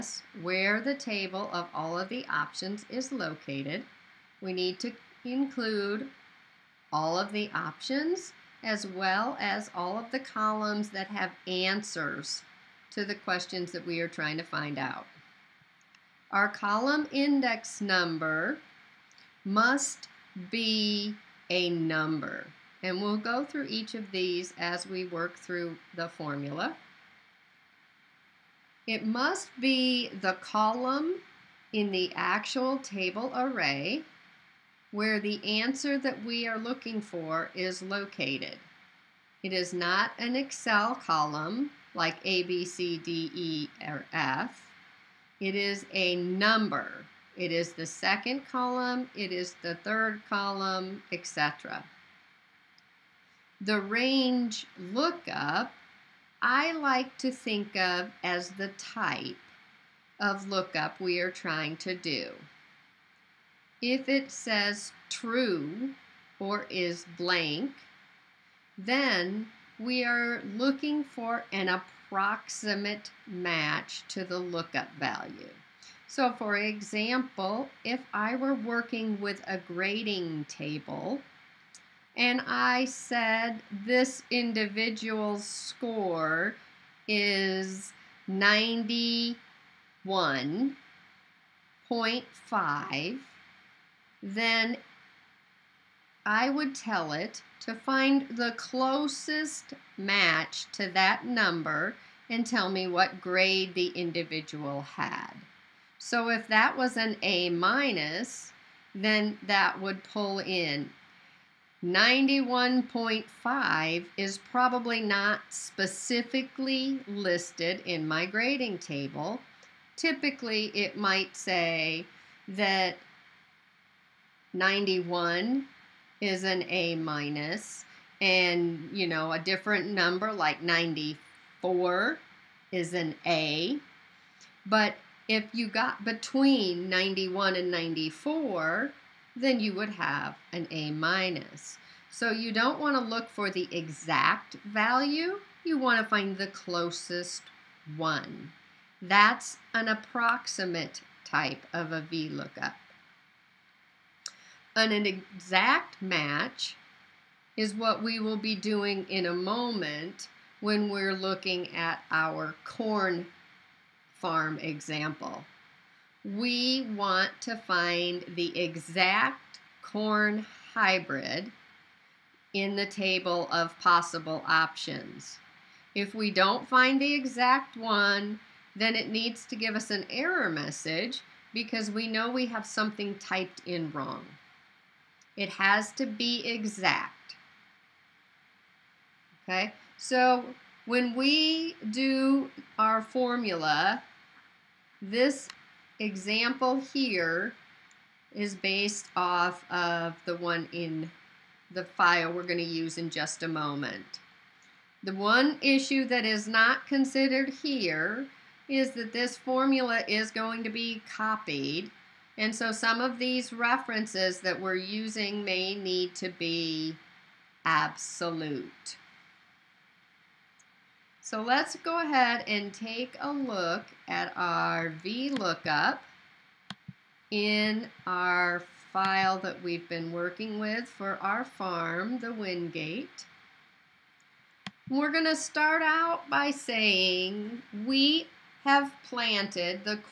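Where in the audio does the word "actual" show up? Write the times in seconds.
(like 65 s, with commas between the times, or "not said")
32 s.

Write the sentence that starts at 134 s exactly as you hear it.
But if you got between 91 and 94, then you would have an A minus.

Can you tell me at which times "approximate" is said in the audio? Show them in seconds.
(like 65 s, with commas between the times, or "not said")
71 s, 149 s.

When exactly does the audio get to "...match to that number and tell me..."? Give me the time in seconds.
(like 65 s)
99 s.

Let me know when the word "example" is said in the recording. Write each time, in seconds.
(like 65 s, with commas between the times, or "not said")
76 s, 164 s, 195 s.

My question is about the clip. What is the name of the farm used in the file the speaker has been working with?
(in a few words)
Wingate.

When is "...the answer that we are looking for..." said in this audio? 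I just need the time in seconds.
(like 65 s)
35 s.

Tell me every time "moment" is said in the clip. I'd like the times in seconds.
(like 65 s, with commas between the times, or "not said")
159 s, 203 s.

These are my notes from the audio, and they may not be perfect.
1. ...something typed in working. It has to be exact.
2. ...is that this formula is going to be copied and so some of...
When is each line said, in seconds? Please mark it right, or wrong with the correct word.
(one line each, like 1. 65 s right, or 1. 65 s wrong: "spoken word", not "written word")
1. 182 s wrong: "wrong", not "working"
2. 208 s right.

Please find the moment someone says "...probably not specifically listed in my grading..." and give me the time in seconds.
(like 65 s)
114 s.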